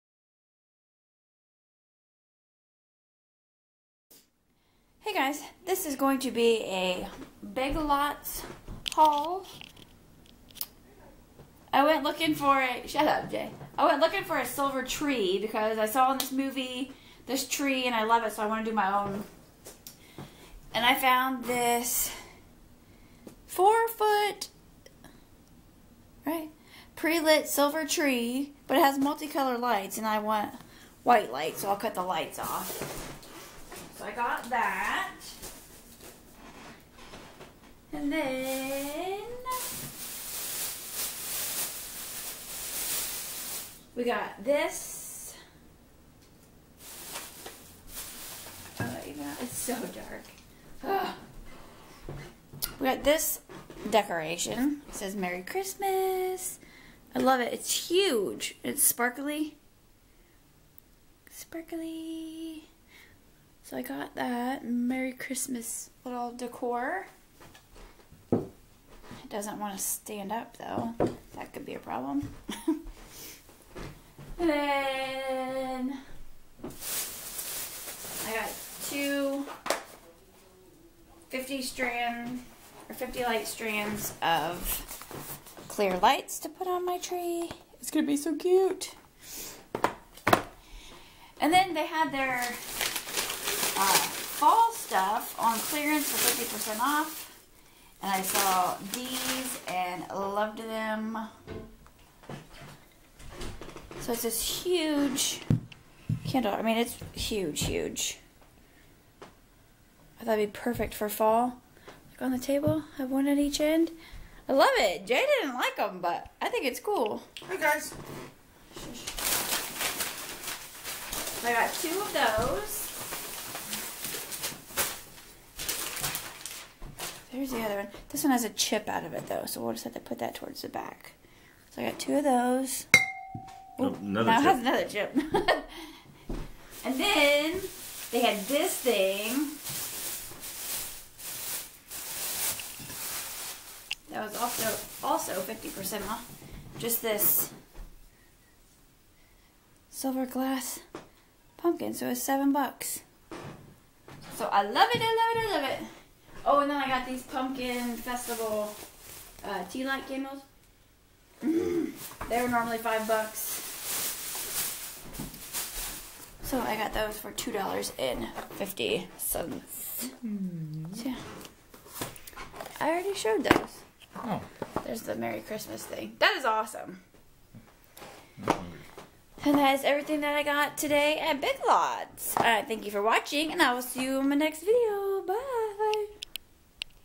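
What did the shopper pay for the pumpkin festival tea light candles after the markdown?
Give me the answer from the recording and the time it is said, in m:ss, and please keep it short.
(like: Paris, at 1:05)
$2.50, at 2:47.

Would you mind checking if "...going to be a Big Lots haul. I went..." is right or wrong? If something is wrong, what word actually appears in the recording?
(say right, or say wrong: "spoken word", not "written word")
right.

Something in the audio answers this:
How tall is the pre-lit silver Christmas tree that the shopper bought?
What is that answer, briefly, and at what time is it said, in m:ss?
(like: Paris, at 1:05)
4 feet, at 0:23.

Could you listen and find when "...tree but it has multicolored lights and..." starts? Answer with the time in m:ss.
0:27.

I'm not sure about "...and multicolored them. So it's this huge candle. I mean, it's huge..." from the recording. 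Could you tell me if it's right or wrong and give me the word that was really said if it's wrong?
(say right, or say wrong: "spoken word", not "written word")
wrong: "loved", not "multicolored".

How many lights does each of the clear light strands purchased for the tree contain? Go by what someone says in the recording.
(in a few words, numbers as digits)
50.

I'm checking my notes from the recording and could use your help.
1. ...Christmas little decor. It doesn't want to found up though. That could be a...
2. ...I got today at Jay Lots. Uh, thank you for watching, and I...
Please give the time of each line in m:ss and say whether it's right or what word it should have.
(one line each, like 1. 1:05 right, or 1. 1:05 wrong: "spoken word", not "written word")
1. 1:05 wrong: "stand", not "found"
2. 3:00 wrong: "Big", not "Jay".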